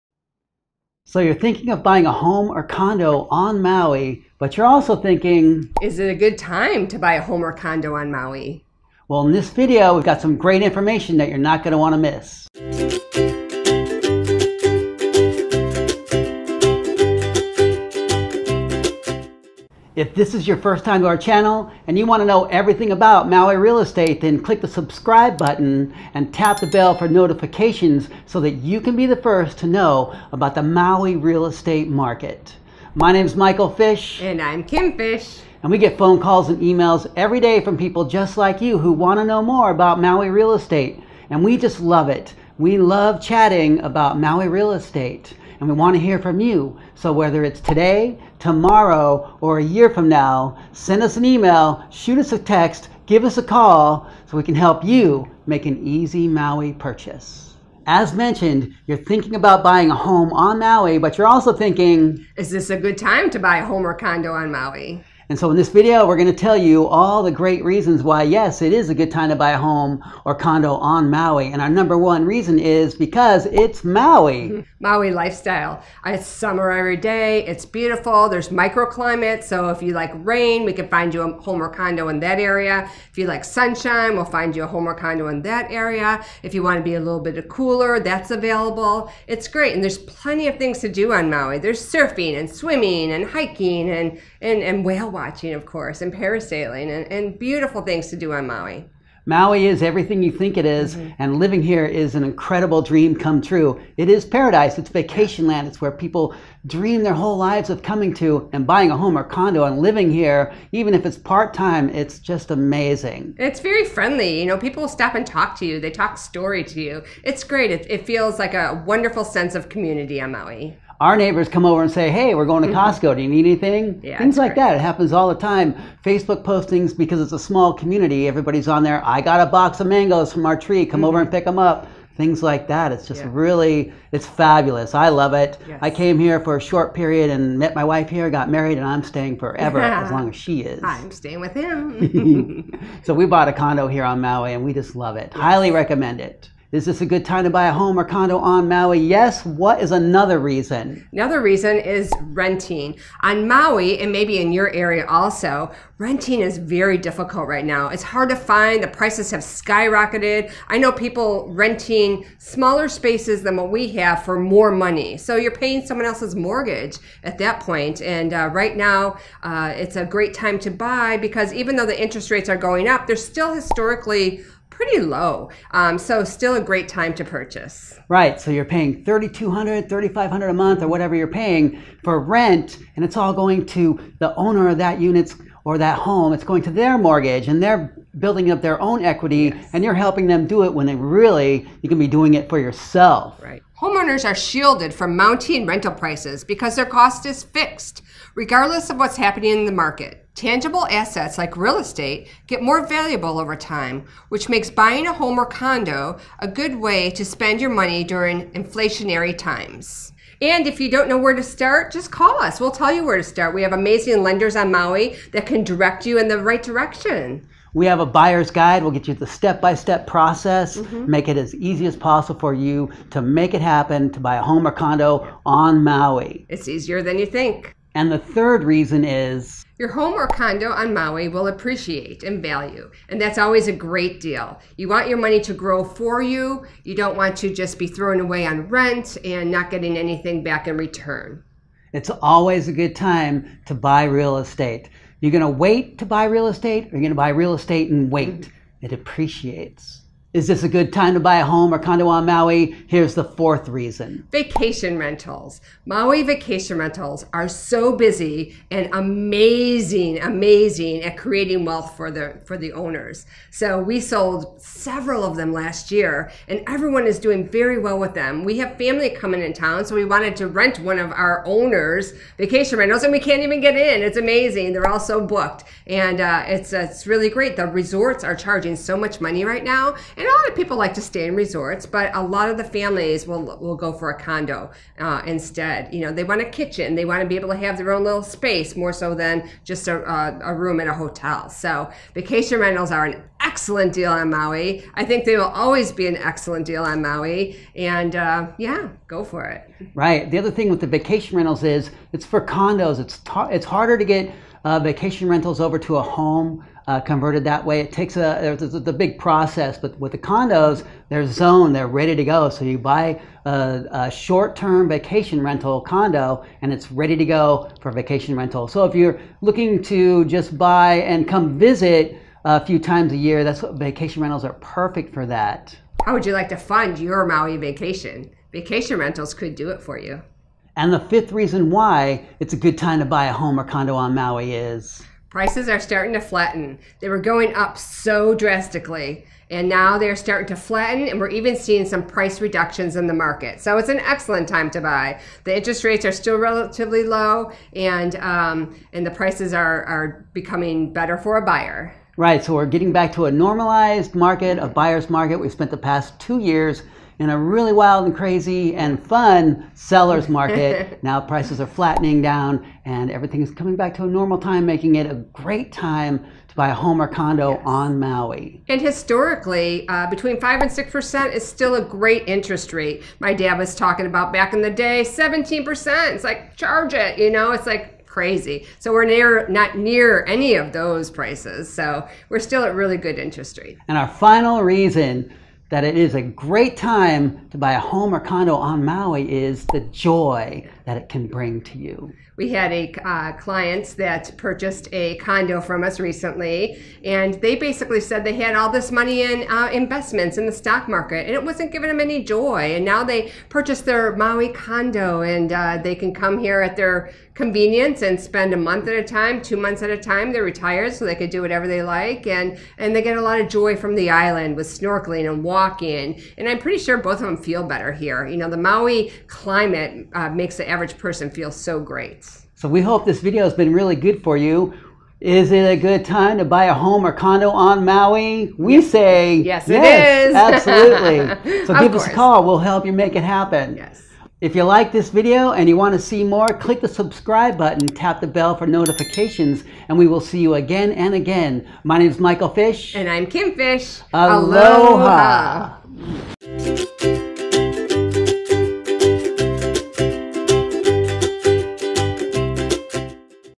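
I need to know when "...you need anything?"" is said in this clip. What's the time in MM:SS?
02:03.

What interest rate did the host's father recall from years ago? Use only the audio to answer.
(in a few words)
17%.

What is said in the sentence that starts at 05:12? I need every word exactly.
So you buy a, a short-term vacation rental condo, and it's ready to go for vacation rental.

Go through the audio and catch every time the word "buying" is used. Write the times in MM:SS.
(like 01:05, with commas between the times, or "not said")
00:01, 00:59, 01:48, 03:24.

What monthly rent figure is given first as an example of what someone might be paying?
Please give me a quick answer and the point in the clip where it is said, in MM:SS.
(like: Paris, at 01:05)
3200, at 02:59.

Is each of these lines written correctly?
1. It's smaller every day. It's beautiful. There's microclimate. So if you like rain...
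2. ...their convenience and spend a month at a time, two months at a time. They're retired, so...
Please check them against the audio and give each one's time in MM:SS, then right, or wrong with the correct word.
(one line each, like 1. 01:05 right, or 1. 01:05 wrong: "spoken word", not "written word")
1. 01:16 wrong: "summer", not "smaller"
2. 06:46 right.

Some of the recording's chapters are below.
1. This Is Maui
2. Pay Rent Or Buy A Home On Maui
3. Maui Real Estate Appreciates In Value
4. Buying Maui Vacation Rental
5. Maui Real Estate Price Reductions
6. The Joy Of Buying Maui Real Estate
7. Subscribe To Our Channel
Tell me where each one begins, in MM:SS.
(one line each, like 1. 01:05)
1. 01:15
2. 02:34
3. 03:51
4. 04:17
5. 05:36
6. 06:32
7. 07:17.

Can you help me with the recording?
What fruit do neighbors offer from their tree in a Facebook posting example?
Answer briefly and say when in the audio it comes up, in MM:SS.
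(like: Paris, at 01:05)
mangoes, at 02:09.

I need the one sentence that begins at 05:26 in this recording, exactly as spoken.
How would you like to fund your Maui vacation?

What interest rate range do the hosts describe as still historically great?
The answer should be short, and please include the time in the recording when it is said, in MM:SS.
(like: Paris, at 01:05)
5 to 6%, at 06:10.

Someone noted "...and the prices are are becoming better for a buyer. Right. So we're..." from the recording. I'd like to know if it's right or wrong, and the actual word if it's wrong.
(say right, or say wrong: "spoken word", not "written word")
right.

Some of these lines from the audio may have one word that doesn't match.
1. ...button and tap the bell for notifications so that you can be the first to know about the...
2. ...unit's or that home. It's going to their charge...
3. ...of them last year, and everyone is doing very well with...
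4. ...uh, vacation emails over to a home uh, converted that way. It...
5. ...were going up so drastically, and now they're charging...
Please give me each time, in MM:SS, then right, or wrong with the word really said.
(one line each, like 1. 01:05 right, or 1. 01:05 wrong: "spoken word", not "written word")
1. 00:25 right
2. 03:04 wrong: "mortgage", not "charge"
3. 04:25 right
4. 05:04 wrong: "rentals", not "emails"
5. 05:37 wrong: "starting", not "charging".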